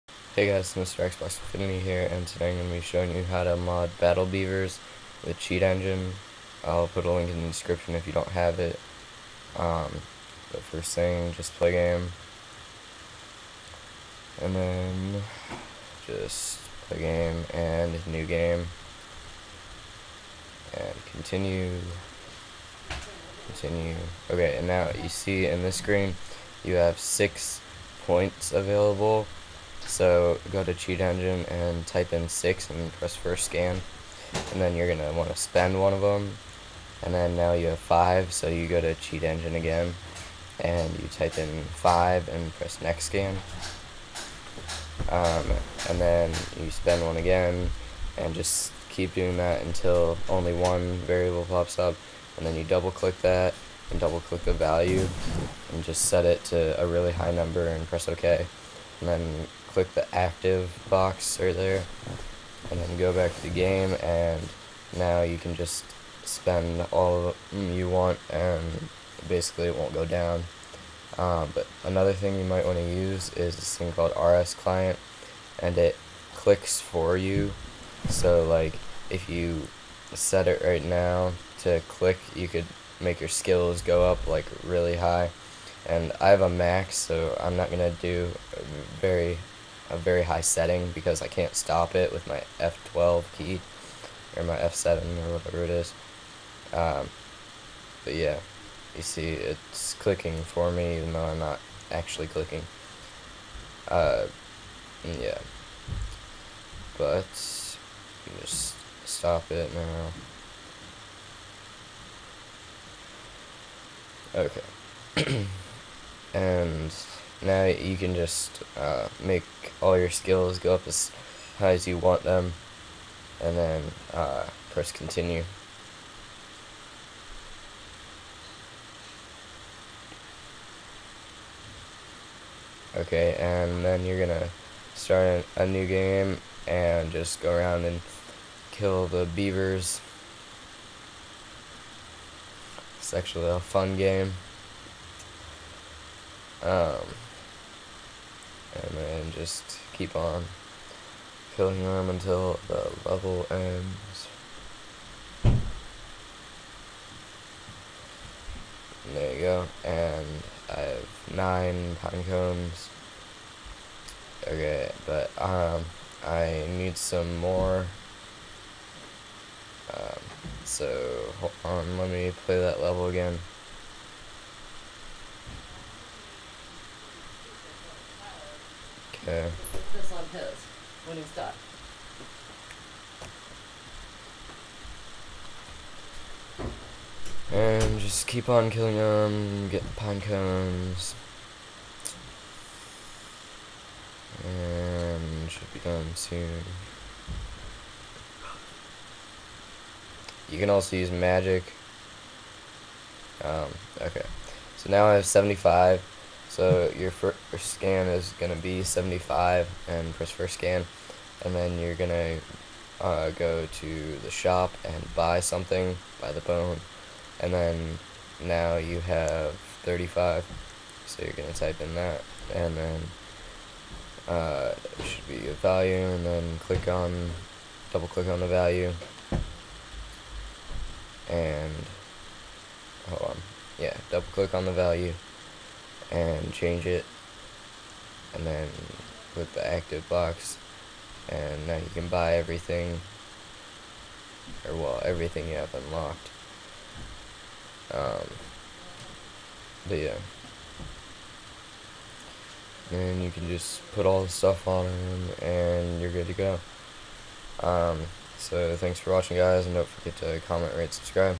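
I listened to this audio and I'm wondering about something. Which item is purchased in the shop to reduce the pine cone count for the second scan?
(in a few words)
the bone.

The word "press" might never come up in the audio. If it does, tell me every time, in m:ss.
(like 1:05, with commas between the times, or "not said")
0:32, 0:42, 0:57, 2:04, 3:30.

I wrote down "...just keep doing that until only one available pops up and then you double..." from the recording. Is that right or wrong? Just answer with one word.
wrong.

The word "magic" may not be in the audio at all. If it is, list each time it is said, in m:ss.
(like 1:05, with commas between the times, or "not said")
3:21.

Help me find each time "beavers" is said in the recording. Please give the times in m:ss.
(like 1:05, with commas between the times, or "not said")
0:04, 2:19.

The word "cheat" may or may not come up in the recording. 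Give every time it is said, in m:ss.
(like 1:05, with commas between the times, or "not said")
0:05, 0:30, 0:38.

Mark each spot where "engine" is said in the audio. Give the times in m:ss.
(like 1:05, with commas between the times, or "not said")
0:05, 0:31, 0:39.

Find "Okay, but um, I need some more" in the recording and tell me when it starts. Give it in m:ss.
2:44.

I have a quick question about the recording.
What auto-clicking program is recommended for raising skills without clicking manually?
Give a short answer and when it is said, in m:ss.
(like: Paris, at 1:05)
RS client, at 1:14.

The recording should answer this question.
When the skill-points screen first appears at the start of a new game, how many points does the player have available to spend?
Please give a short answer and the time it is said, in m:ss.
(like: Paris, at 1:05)
6, at 0:26.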